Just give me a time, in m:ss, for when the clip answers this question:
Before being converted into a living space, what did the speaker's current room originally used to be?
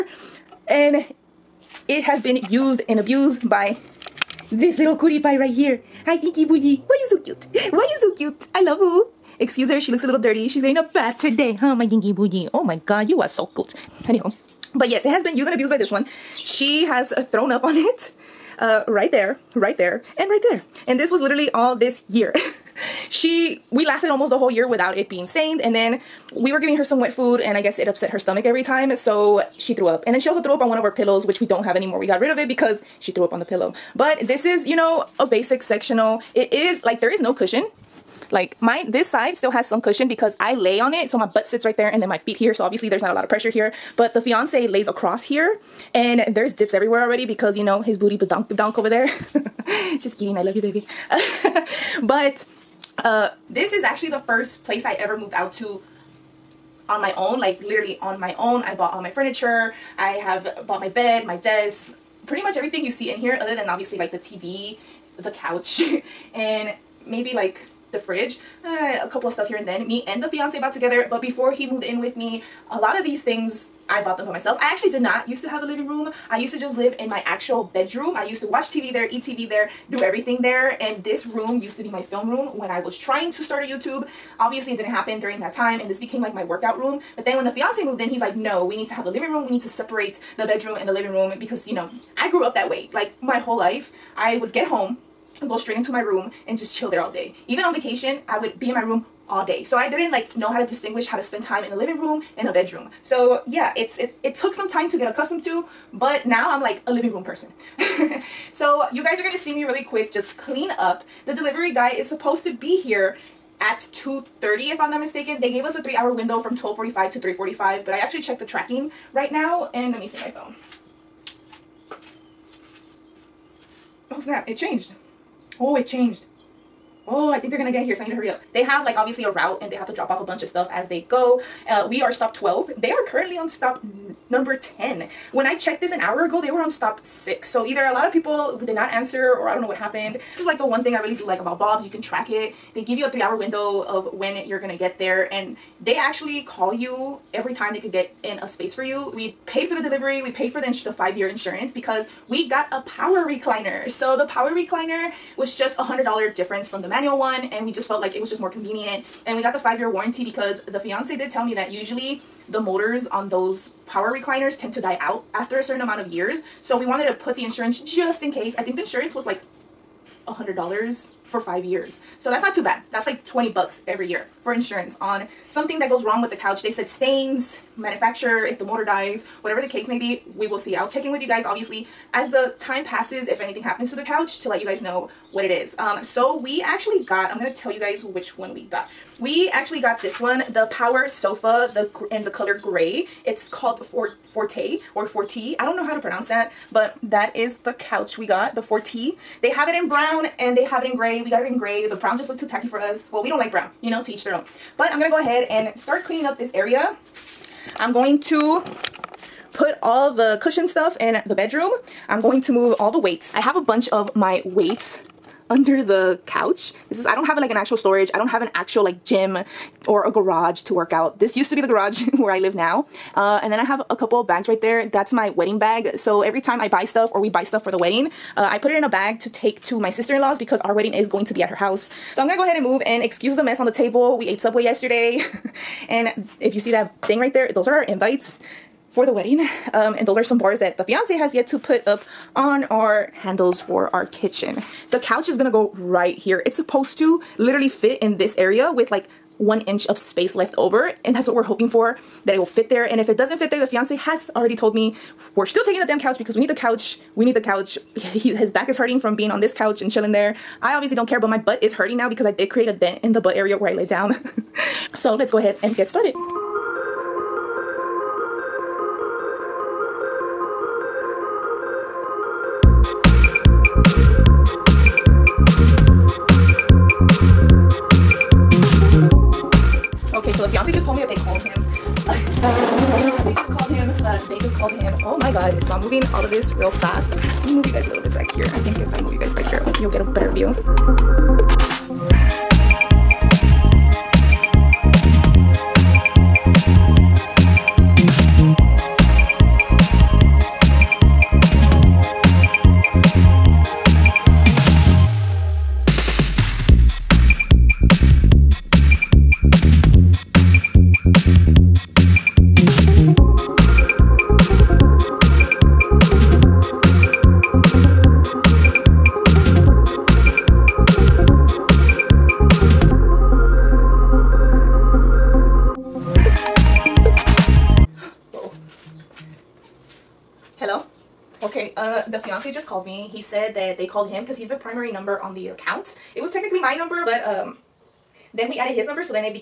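3:41.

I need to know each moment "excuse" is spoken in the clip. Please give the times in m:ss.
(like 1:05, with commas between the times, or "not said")
0:09, 3:53.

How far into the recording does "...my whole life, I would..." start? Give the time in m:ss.
1:33.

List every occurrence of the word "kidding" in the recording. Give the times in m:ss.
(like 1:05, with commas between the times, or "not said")
0:50.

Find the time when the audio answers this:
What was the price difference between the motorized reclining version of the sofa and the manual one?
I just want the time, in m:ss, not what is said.
2:35.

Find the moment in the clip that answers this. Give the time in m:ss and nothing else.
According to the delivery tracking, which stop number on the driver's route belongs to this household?
2:11.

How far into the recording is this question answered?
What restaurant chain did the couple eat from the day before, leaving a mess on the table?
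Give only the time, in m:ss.
3:54.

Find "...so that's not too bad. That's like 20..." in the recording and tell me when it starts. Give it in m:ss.
2:52.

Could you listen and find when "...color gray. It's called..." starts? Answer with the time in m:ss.
3:12.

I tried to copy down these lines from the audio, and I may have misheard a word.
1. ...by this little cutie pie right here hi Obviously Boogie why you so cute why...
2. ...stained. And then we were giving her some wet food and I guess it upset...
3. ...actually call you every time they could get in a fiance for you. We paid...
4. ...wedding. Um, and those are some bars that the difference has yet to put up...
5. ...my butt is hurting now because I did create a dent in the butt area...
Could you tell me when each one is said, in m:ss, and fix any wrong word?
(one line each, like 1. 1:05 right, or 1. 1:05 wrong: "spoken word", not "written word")
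1. 0:03 wrong: "Tinky", not "Obviously"
2. 0:25 right
3. 2:25 wrong: "space", not "fiance"
4. 3:59 wrong: "fiance", not "difference"
5. 4:21 right.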